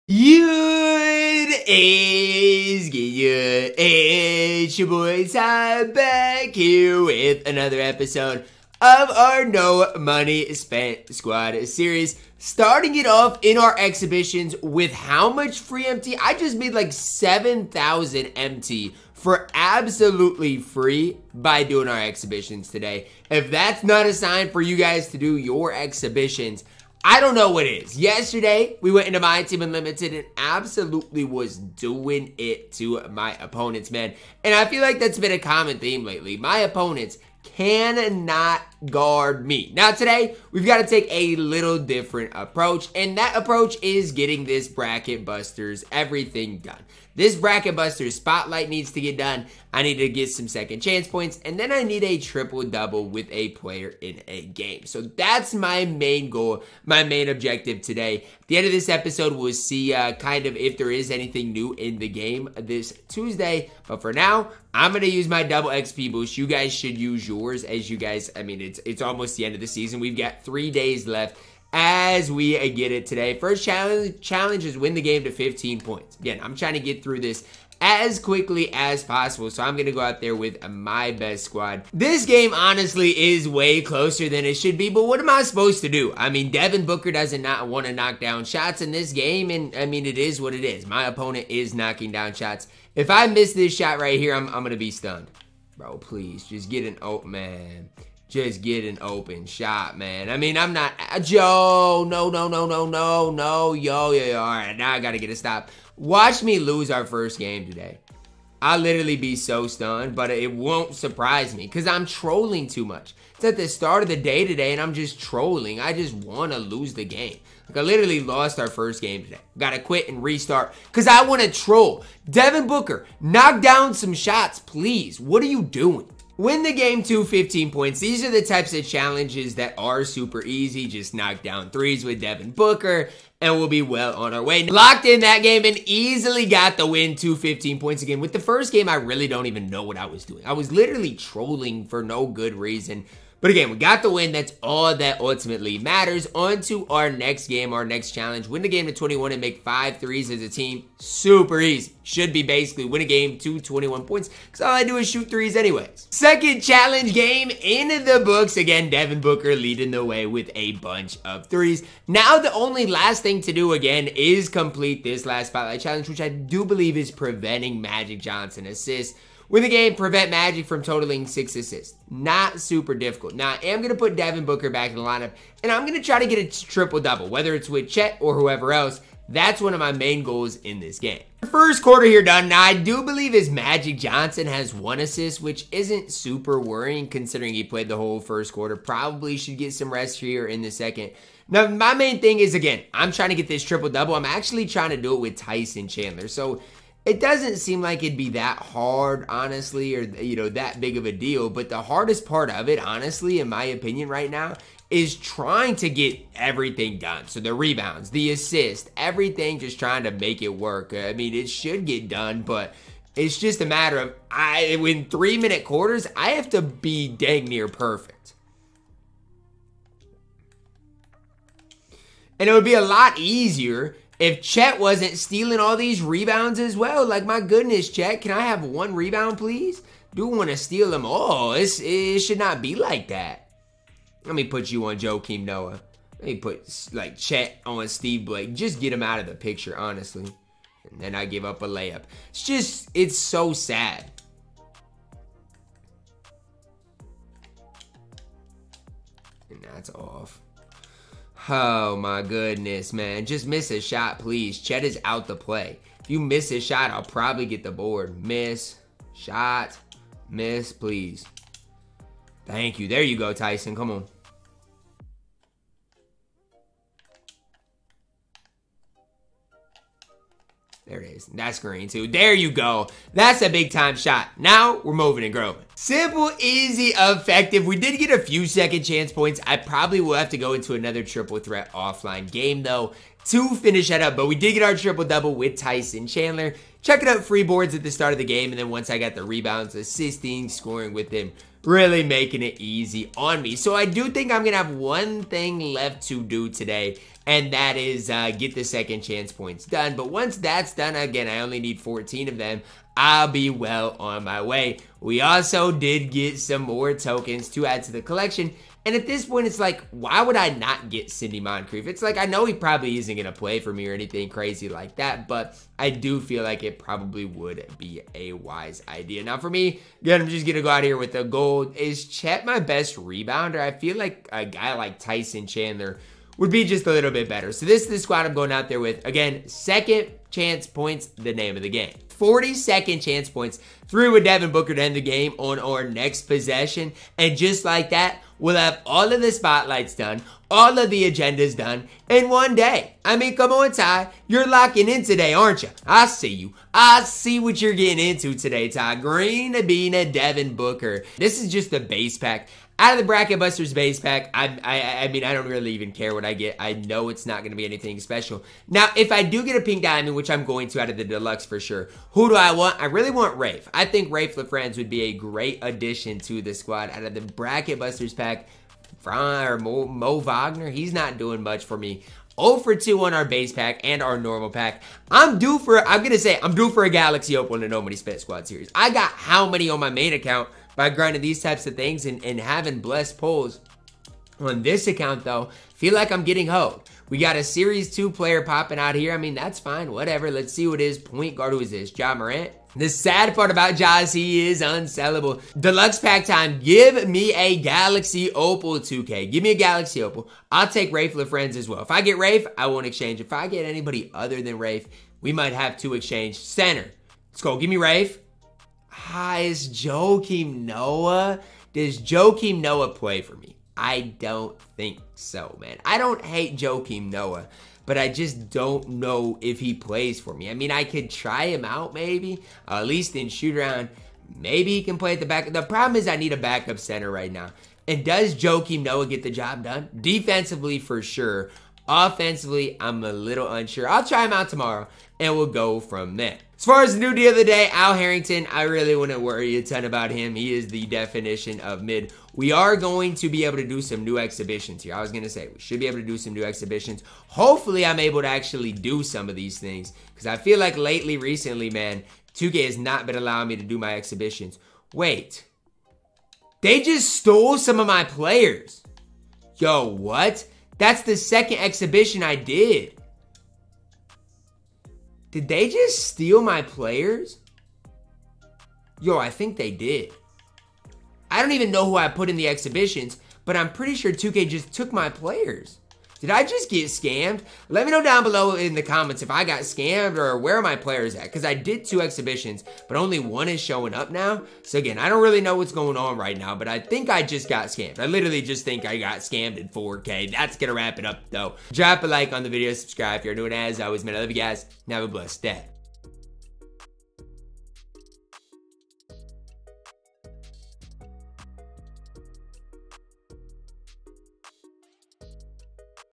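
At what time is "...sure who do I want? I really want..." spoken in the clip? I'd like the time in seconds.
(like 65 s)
361 s.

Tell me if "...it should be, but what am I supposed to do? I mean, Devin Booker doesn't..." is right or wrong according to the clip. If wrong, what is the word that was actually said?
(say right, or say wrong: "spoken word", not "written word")
right.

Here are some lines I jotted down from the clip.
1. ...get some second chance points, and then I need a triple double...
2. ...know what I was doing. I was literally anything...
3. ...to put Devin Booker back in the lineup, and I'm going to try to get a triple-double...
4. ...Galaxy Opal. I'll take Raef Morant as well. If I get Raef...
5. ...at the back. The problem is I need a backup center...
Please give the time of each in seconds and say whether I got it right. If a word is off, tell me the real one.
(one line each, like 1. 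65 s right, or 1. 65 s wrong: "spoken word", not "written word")
1. 50 s right
2. 139 s wrong: "trolling", not "anything"
3. 173 s right
4. 399 s wrong: "LaFrentz", not "Morant"
5. 425 s right.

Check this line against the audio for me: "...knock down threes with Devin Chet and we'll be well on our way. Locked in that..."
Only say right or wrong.
wrong.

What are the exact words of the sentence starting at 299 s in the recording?
But once that's done, again, I only need 14 of them.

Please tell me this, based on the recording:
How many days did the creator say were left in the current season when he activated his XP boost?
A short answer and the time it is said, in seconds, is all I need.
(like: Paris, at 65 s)
3, at 70 s.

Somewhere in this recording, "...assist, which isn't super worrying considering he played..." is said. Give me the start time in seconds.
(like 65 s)
185 s.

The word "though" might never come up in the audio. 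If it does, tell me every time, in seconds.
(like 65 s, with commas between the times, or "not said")
282 s, 385 s, 491 s.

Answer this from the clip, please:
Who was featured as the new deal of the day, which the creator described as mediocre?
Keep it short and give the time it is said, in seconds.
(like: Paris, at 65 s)
Al Harrington, at 437 s.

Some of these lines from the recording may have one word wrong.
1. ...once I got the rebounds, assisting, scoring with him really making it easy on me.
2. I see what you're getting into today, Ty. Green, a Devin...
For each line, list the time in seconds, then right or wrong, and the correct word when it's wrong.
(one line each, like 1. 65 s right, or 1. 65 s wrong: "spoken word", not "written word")
1. 288 s right
2. 346 s right.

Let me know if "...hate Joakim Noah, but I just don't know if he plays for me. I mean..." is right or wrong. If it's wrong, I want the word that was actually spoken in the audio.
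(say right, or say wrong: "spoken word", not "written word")
right.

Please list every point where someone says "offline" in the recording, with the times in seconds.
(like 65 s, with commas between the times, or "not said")
281 s.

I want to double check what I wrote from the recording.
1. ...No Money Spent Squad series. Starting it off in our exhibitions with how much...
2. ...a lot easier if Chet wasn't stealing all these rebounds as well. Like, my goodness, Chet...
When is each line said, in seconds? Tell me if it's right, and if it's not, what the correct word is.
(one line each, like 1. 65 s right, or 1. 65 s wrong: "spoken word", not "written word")
1. 9 s right
2. 222 s right.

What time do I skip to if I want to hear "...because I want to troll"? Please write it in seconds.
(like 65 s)
120 s.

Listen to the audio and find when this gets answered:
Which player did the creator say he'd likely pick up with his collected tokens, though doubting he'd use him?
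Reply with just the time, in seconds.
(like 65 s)
311 s.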